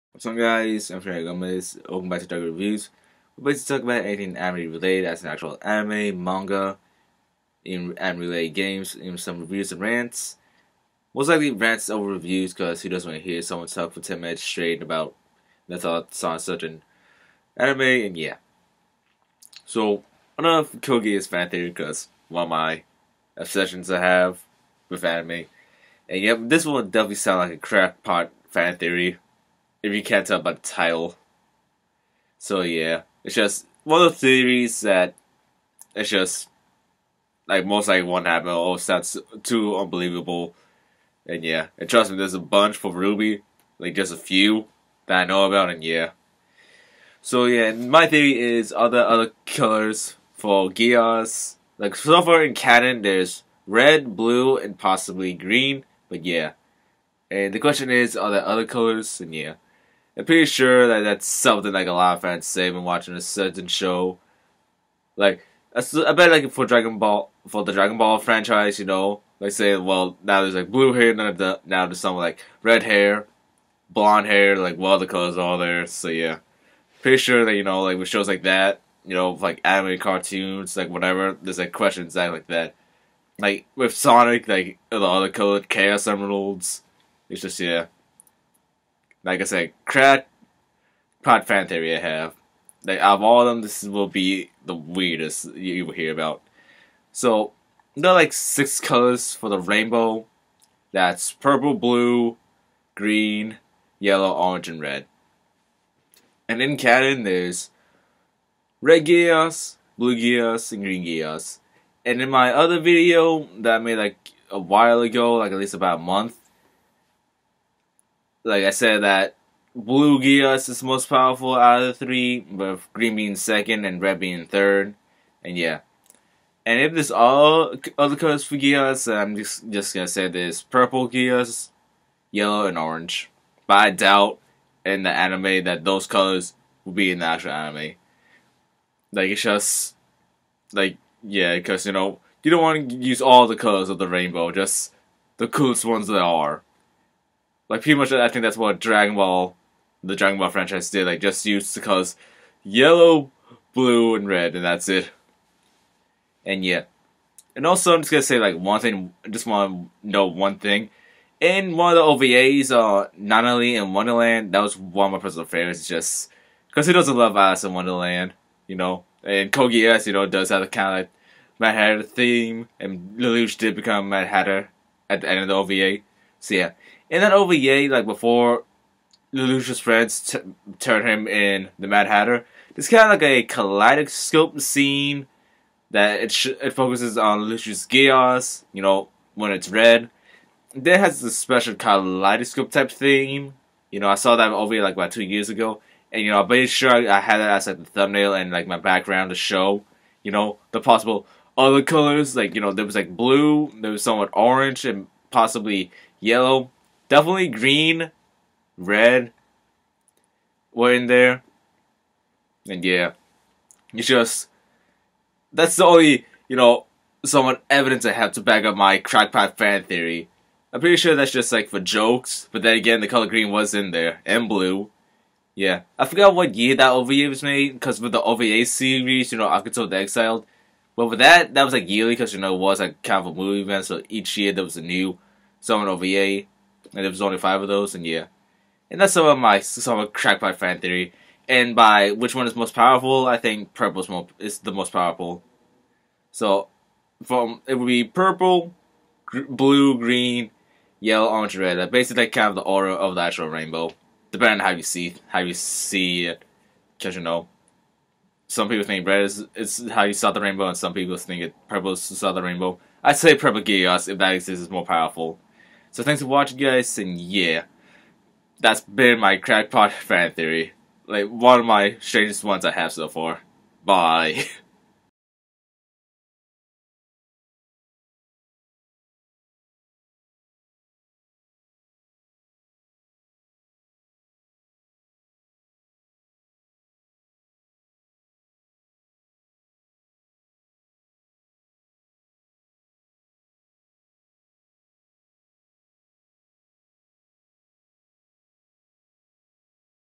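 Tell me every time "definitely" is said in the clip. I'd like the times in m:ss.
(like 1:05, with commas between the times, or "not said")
0:26, 3:27.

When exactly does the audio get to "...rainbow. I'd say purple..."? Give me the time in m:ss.
4:22.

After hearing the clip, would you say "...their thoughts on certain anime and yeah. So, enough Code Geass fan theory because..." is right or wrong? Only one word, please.
right.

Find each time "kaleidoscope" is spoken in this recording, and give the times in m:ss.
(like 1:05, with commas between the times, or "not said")
3:03, 3:11.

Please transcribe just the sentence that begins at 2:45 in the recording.
It's just because who doesn't love Alice in Wonderland, you know?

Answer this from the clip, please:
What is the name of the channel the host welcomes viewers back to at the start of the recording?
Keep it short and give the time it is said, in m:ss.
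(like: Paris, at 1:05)
Dark Reviews, at 0:02.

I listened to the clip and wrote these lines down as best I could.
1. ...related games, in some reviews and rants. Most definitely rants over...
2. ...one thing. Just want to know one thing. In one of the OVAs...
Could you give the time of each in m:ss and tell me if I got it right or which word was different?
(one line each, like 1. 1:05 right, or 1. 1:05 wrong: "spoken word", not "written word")
1. 0:08 wrong: "likely", not "definitely"
2. 2:38 right.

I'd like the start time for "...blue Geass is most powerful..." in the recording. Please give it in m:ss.
1:59.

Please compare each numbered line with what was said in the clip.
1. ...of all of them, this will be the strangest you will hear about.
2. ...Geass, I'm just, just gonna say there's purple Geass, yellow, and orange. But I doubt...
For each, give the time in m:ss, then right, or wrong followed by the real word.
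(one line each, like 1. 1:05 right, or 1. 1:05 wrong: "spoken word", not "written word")
1. 1:33 wrong: "weirdest", not "strangest"
2. 2:08 right.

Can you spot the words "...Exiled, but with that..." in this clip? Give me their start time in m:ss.
3:49.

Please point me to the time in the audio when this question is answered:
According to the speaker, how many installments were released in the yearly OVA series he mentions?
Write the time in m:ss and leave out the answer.
3:57.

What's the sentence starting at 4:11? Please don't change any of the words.
Basically, kind of the aura of the actual rainbow, depending on how you see how you see it.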